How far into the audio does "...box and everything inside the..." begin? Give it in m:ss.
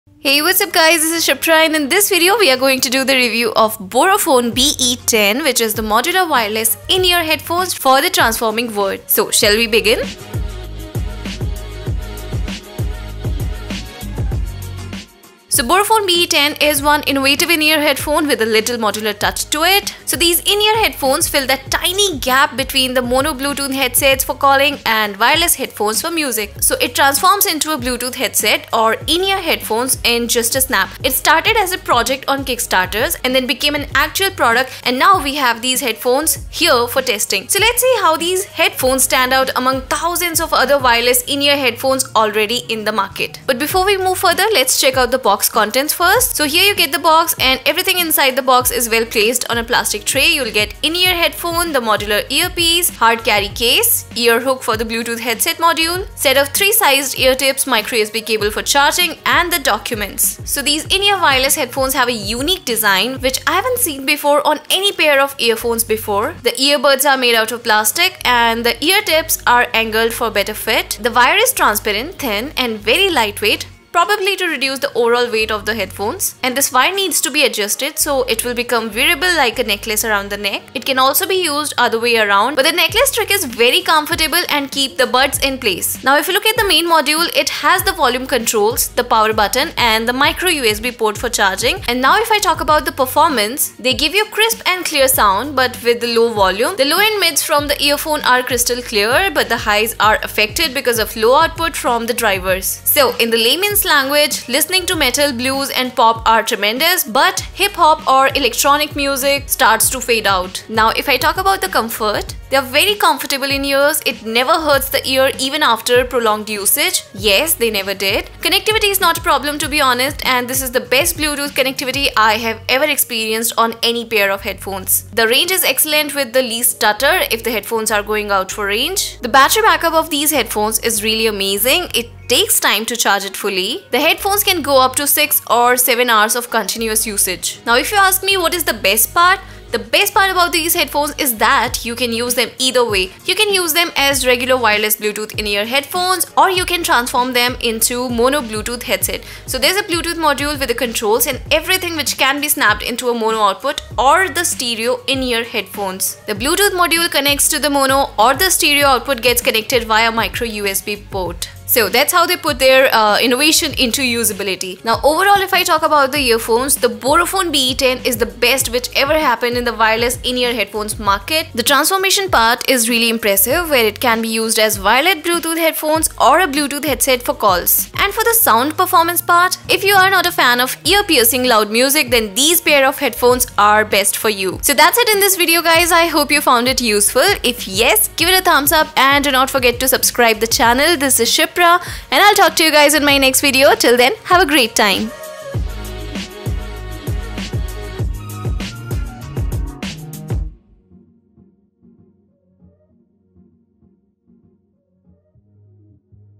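0:46.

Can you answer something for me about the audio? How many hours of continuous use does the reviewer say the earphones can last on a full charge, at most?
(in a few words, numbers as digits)
7.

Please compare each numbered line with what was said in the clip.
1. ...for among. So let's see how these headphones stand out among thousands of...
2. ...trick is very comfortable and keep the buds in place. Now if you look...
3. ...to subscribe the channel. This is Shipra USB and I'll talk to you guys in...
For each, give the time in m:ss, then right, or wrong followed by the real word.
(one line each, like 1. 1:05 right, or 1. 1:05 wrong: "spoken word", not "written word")
1. 0:36 wrong: "testing", not "among"
2. 1:23 right
3. 3:09 wrong: "Chopra", not "USB".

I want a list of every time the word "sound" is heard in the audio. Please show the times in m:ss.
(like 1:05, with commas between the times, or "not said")
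1:35, 2:58.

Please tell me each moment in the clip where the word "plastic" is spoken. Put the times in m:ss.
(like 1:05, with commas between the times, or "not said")
0:49, 1:07.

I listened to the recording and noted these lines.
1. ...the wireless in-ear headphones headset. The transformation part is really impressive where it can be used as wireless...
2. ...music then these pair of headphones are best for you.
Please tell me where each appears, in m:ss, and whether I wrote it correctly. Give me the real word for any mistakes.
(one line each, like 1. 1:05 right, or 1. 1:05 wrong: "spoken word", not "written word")
1. 2:49 wrong: "market", not "headset"
2. 3:01 right.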